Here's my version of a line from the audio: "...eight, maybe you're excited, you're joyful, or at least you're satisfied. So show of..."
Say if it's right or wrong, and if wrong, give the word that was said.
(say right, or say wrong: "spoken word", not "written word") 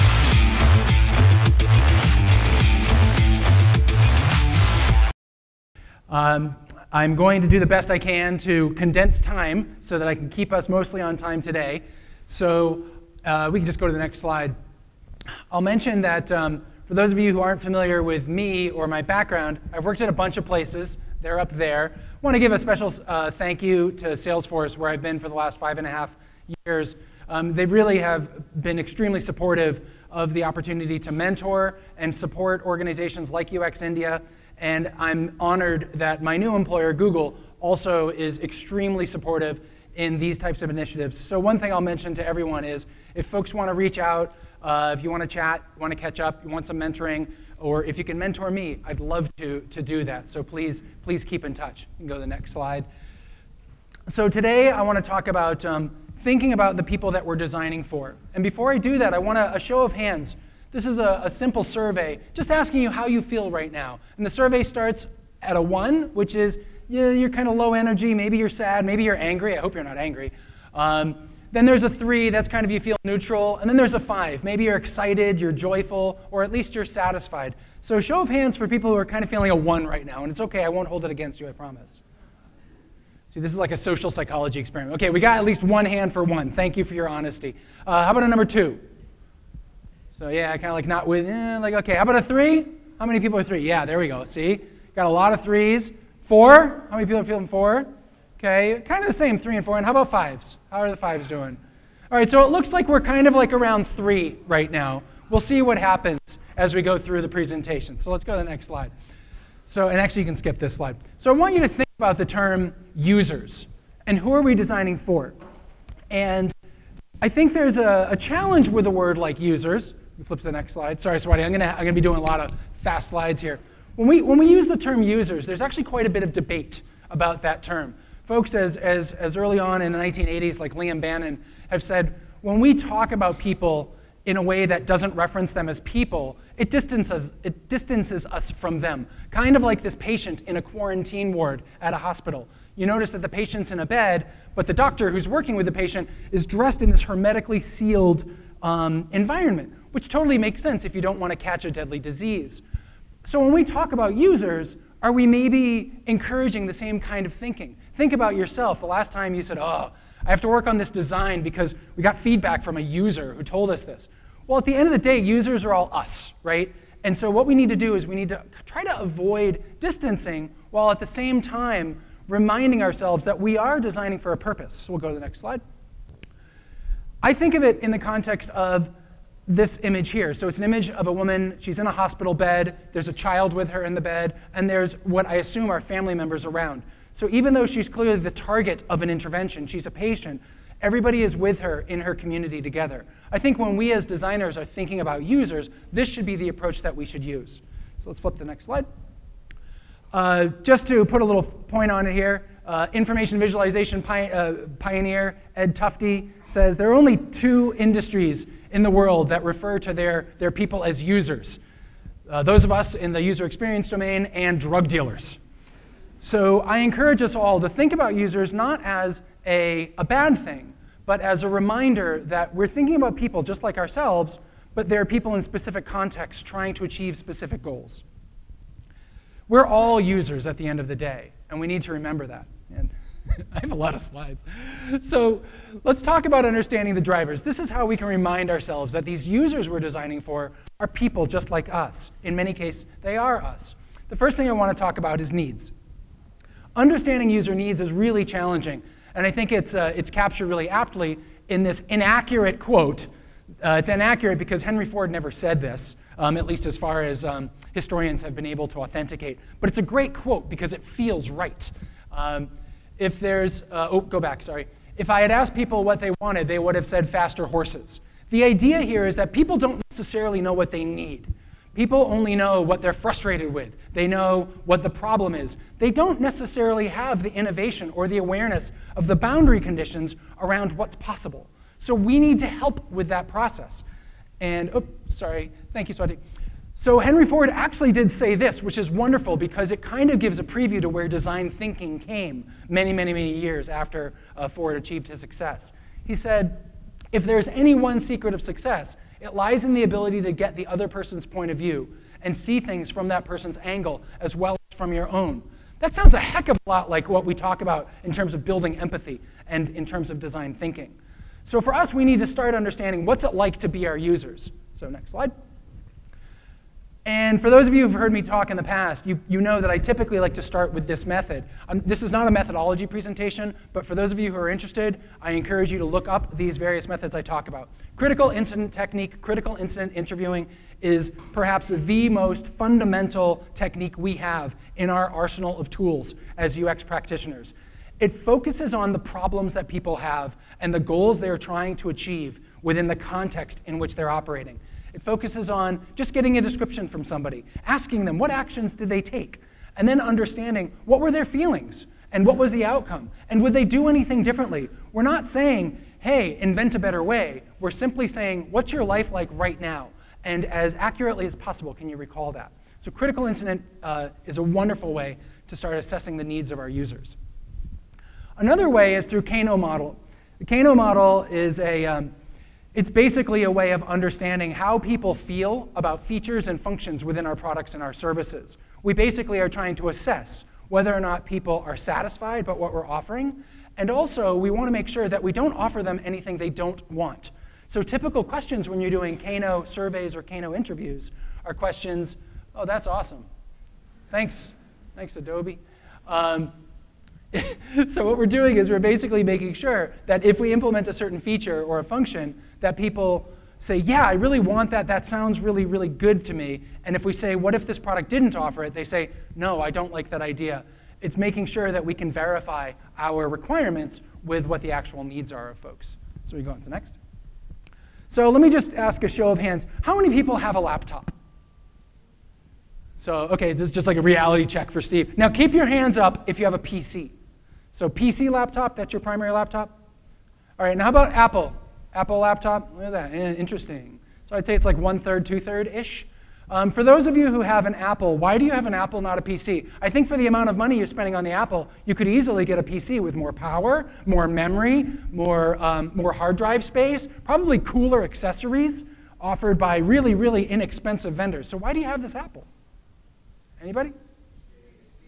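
wrong: "five", not "eight".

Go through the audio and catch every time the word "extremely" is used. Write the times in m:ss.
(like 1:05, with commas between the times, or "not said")
0:28, 0:38.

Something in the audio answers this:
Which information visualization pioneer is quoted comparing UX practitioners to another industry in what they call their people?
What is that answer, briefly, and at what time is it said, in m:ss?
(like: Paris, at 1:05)
Ed Tufte, at 3:25.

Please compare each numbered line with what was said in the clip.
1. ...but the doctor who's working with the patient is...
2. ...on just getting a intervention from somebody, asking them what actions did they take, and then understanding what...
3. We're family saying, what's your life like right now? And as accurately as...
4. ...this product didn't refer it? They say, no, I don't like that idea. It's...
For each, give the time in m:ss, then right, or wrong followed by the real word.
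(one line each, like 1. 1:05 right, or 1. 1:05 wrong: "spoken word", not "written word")
1. 2:24 right
2. 5:45 wrong: "description", not "intervention"
3. 5:57 wrong: "simply", not "family"
4. 6:47 wrong: "offer", not "refer".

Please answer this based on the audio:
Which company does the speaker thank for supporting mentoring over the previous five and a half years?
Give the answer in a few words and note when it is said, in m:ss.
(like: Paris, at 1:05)
Salesforce, at 0:24.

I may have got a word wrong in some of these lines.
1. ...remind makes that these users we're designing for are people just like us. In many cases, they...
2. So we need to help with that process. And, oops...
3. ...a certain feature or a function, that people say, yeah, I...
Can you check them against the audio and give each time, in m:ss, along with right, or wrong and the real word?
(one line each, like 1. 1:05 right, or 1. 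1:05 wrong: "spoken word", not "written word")
1. 3:58 wrong: "ourselves", not "makes"
2. 4:41 right
3. 6:40 right.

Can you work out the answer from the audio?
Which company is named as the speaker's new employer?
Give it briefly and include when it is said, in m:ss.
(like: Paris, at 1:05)
Google, at 0:36.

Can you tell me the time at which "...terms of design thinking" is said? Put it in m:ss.
5:09.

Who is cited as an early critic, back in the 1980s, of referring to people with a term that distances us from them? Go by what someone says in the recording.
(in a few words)
Liam Bannon.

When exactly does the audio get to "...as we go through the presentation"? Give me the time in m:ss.
1:46.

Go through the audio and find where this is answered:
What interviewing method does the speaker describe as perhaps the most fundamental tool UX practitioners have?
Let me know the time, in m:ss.
5:27.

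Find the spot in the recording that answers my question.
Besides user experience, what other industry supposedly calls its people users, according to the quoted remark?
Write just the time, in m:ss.
3:34.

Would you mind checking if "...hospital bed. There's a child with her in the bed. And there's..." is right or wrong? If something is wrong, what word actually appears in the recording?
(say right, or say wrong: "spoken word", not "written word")
right.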